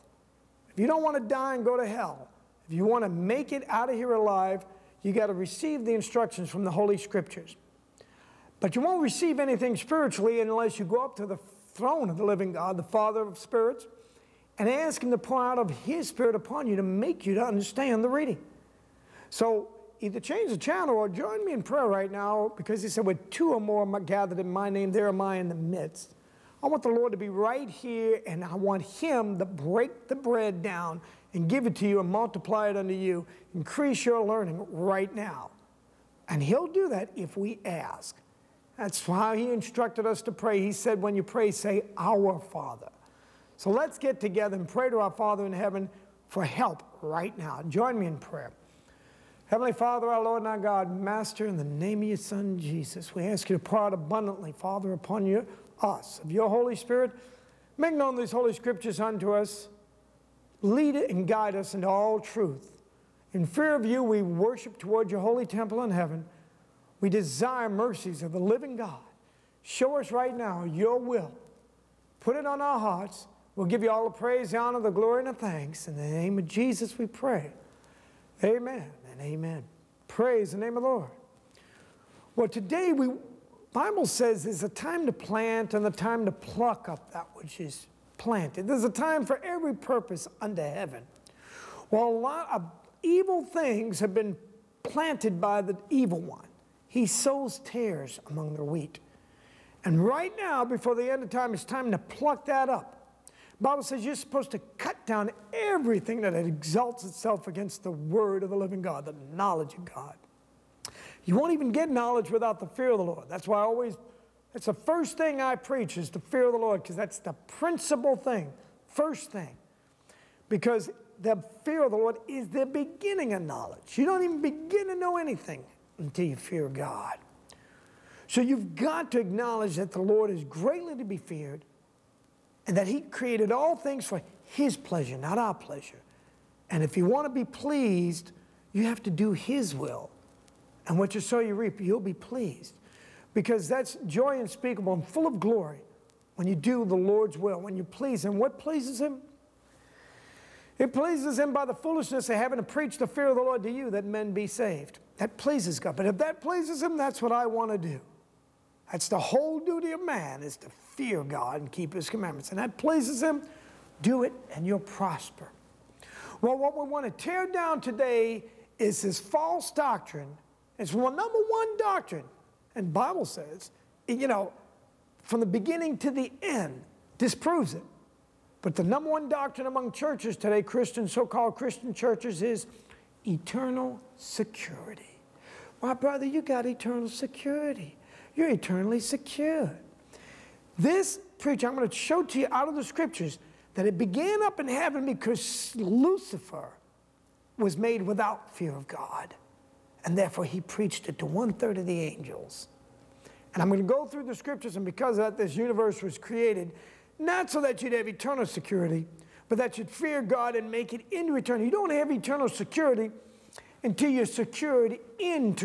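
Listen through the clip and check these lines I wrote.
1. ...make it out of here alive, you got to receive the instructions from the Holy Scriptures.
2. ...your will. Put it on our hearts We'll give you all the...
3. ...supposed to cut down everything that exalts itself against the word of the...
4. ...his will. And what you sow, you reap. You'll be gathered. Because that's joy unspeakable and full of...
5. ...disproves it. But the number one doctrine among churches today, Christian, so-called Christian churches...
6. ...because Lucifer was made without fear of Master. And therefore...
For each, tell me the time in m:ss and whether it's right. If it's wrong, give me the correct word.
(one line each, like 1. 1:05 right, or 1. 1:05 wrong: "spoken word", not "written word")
1. 0:03 right
2. 1:10 right
3. 1:44 right
4. 2:19 wrong: "pleased", not "gathered"
5. 2:57 right
6. 3:15 wrong: "God", not "Master".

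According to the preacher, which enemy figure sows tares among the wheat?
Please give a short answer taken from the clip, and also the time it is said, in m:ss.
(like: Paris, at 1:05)
the evil one, at 1:35.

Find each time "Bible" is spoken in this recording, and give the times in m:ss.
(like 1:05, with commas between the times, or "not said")
1:23, 1:43, 2:52.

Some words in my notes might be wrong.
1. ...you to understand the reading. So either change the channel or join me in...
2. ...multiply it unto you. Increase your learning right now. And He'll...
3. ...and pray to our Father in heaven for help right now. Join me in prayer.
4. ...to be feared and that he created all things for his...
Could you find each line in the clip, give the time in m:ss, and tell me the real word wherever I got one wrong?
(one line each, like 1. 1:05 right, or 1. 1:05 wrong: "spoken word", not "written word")
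1. 0:17 right
2. 0:32 right
3. 0:44 right
4. 2:10 right.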